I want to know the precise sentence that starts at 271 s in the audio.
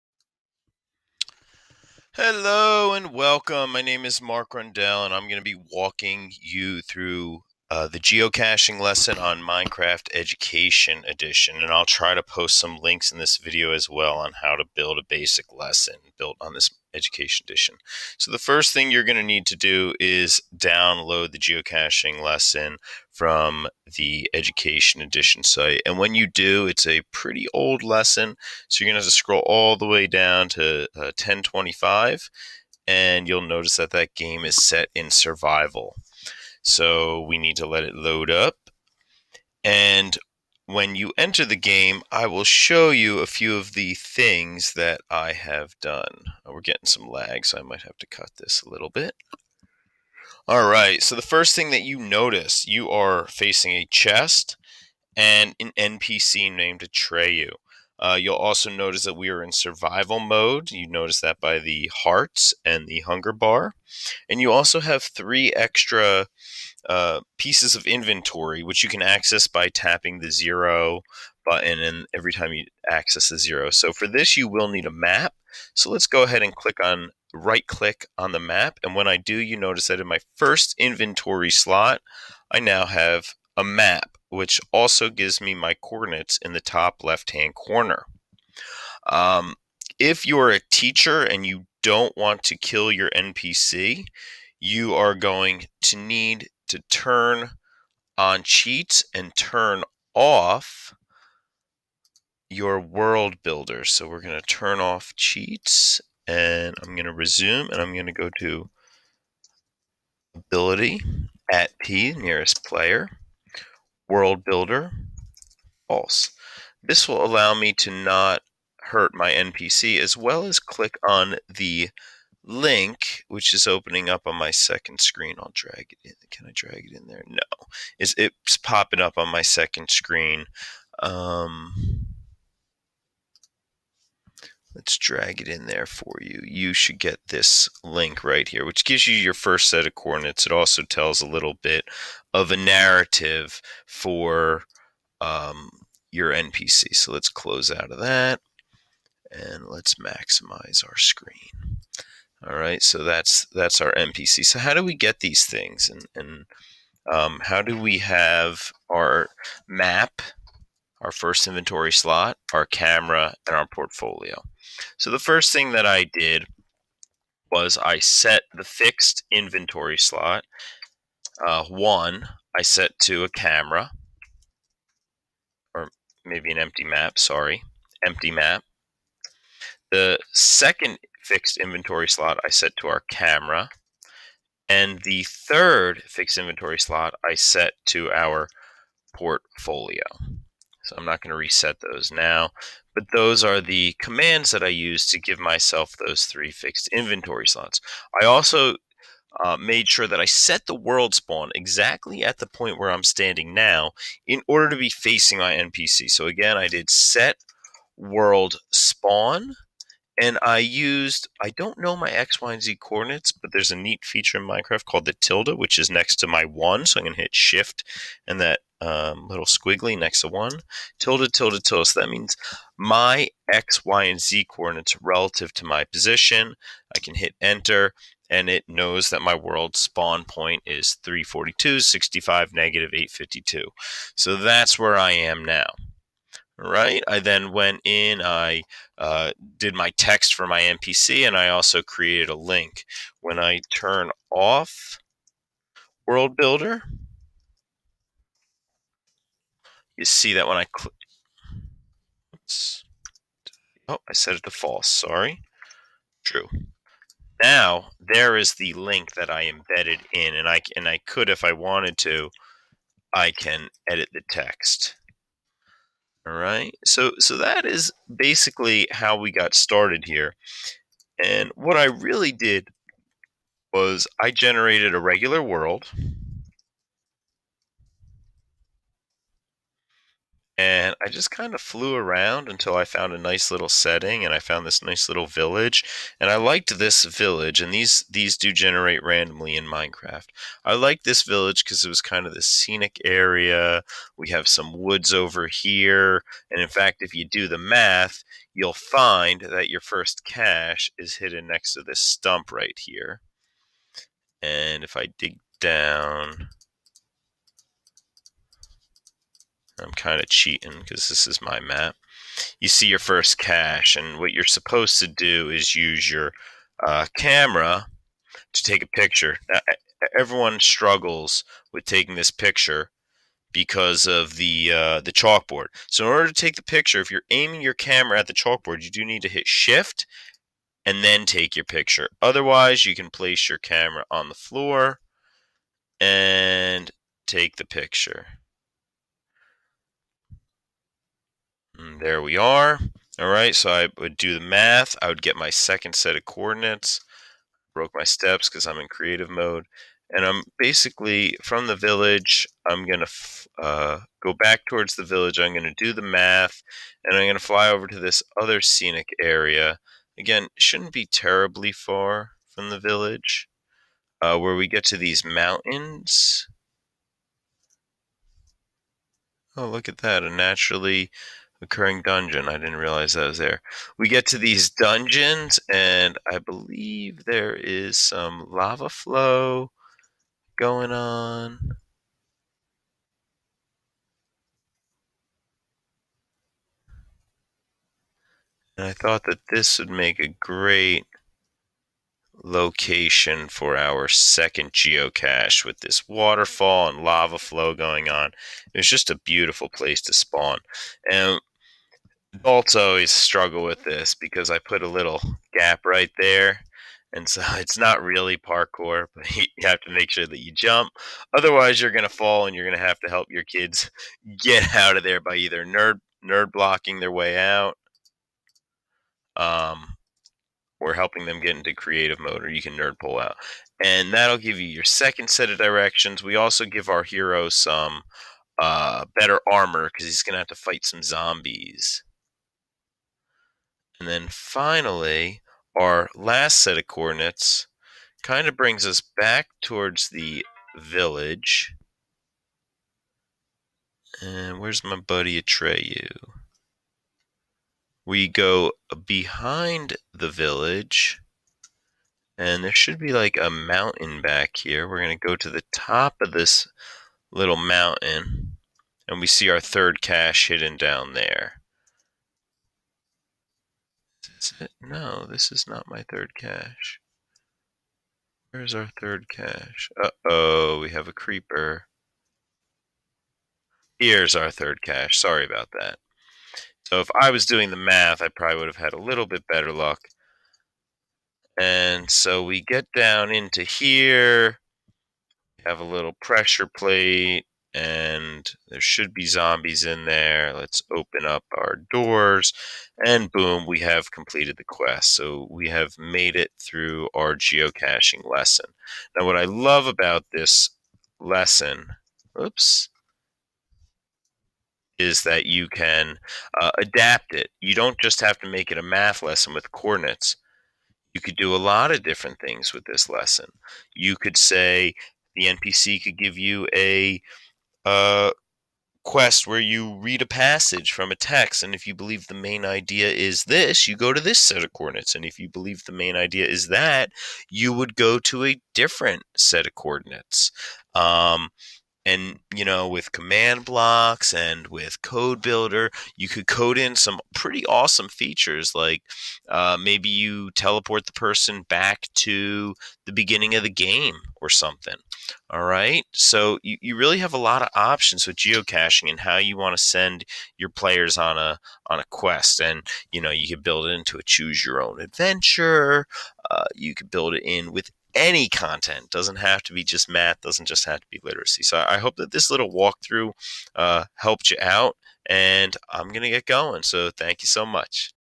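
And what I really did was I generated a regular world.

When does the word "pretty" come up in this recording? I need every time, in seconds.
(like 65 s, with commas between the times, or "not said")
27 s, 537 s.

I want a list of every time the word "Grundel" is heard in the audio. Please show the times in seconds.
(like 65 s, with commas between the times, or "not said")
4 s.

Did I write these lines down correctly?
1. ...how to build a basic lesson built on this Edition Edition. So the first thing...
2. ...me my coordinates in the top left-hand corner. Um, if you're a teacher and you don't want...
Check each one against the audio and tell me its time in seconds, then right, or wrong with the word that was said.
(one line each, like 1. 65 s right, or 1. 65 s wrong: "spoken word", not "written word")
1. 14 s wrong: "Education", not "Edition"
2. 85 s right.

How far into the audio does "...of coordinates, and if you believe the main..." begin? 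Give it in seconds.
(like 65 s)
524 s.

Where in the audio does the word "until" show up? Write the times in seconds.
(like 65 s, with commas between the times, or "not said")
282 s.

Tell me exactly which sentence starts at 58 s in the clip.
Uh, you'll also notice that we are in survival mode.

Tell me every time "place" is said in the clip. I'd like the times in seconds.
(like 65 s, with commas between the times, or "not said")
333 s, 399 s.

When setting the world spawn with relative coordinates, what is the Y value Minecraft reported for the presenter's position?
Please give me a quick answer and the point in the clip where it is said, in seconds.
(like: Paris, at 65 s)
65, at 231 s.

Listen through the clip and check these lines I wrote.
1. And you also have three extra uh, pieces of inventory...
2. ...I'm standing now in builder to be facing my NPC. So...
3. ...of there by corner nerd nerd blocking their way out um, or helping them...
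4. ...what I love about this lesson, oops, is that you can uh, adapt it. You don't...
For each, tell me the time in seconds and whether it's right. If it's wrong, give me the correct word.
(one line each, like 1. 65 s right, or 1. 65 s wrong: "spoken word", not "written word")
1. 64 s right
2. 202 s wrong: "order", not "builder"
3. 414 s wrong: "either", not "corner"
4. 499 s right.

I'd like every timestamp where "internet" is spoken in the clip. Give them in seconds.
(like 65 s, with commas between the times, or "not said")
not said.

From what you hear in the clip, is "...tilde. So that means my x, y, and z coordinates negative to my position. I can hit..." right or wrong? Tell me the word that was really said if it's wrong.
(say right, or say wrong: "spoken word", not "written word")
wrong: "relative", not "negative".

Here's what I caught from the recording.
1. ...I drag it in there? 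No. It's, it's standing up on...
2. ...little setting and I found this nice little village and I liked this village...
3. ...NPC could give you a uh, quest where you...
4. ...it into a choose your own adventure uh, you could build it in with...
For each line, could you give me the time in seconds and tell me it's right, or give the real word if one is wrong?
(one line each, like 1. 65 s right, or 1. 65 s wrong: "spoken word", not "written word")
1. 126 s wrong: "popping", not "standing"
2. 283 s right
3. 515 s right
4. 553 s right.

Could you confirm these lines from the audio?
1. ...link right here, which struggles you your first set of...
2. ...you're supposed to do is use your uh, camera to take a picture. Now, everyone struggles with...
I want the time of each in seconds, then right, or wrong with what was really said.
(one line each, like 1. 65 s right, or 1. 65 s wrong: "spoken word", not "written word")
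1. 137 s wrong: "gives", not "struggles"
2. 314 s right.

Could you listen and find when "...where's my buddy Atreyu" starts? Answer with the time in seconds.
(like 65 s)
444 s.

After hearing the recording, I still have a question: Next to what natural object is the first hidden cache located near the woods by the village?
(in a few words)
stump.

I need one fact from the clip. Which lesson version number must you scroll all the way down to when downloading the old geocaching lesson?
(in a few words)
1025.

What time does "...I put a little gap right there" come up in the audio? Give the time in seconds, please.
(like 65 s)
404 s.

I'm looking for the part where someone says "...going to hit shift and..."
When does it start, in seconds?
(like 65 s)
217 s.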